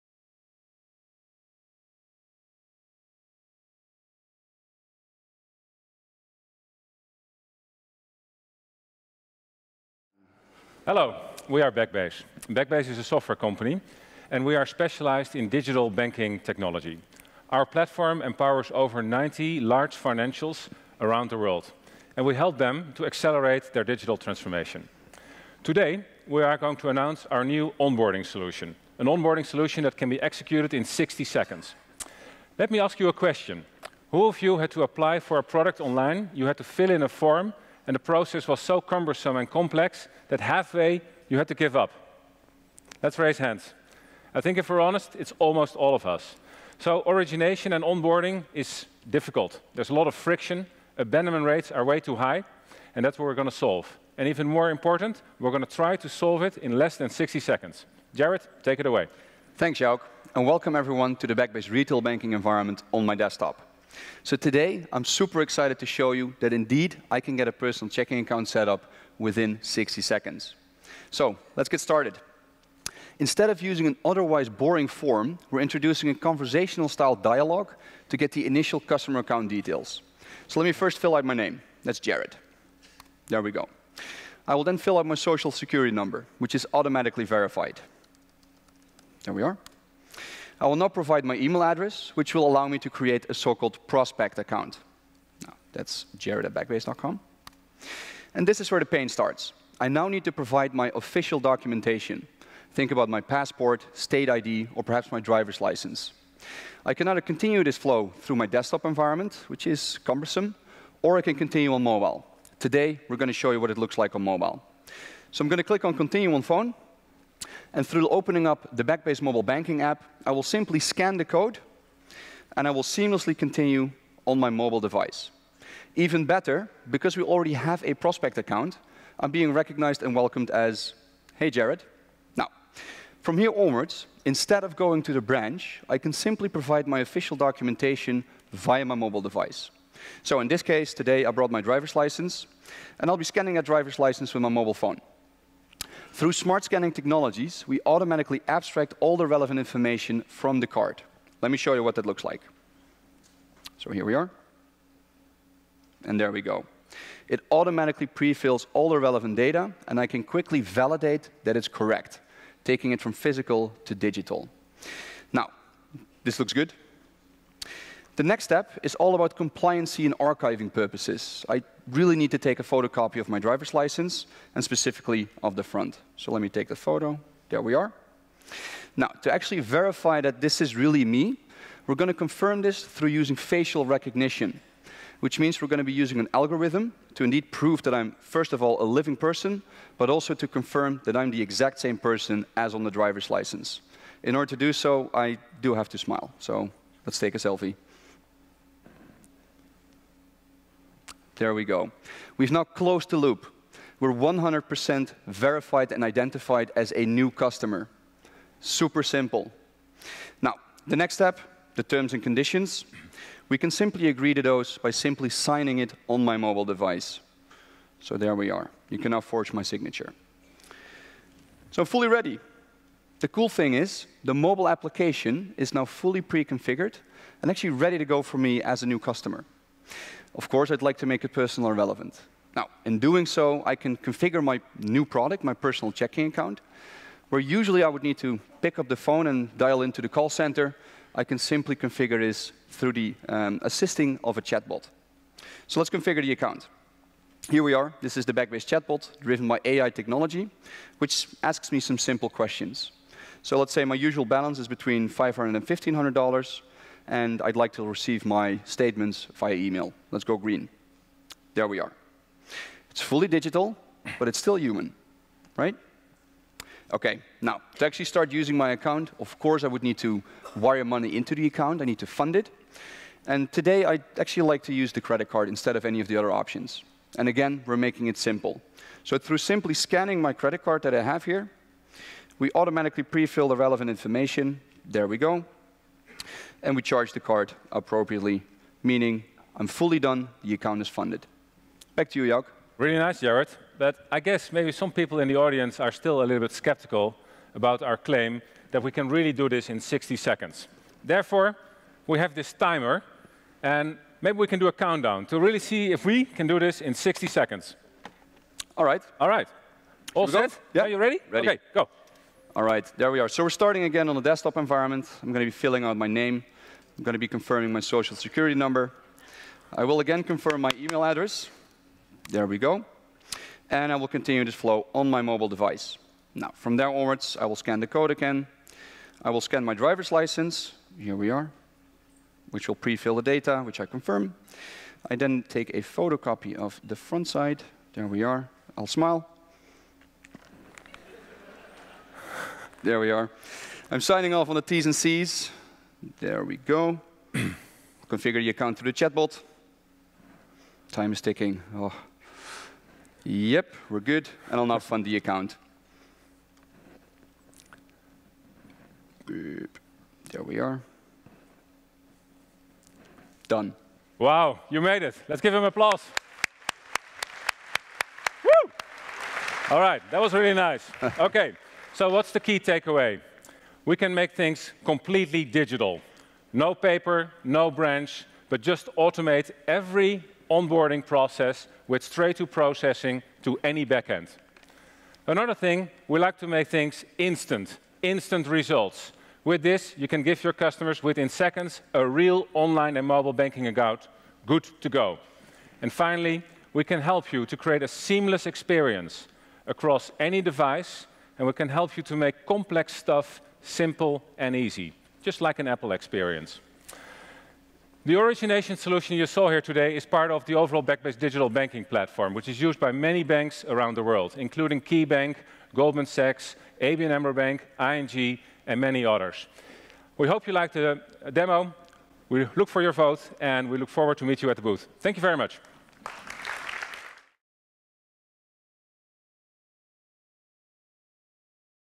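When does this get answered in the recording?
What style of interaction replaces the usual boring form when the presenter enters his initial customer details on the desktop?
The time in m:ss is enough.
1:16.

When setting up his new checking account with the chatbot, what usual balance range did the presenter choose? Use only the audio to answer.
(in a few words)
$500 to $1,500.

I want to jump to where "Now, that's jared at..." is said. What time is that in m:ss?
1:35.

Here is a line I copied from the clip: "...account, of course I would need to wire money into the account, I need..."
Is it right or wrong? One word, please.
right.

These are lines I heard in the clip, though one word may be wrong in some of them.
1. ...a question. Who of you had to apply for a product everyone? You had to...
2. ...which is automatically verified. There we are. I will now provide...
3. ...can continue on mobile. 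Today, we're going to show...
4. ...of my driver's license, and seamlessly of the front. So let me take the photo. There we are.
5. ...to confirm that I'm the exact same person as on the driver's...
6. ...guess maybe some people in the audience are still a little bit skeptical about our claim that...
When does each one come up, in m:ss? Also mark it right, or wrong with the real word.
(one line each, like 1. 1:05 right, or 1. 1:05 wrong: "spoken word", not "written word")
1. 0:33 wrong: "online", not "everyone"
2. 1:26 right
3. 1:51 right
4. 2:53 wrong: "specifically", not "seamlessly"
5. 3:10 right
6. 4:54 right.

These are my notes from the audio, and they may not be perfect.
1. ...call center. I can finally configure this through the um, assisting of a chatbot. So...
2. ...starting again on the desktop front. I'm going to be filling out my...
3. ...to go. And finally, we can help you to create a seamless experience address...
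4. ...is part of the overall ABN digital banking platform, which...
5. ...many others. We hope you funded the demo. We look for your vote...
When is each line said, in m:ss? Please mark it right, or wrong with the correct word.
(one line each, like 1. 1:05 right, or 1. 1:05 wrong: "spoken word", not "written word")
1. 4:00 wrong: "simply", not "finally"
2. 5:13 wrong: "environment", not "front"
3. 6:34 wrong: "across", not "address"
4. 6:49 wrong: "Backbase", not "ABN"
5. 6:58 wrong: "liked", not "funded".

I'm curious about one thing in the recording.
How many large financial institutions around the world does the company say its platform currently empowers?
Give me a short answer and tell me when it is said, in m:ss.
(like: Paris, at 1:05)
over 90, at 0:18.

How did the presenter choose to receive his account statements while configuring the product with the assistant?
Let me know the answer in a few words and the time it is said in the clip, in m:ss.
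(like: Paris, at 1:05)
via email, at 4:19.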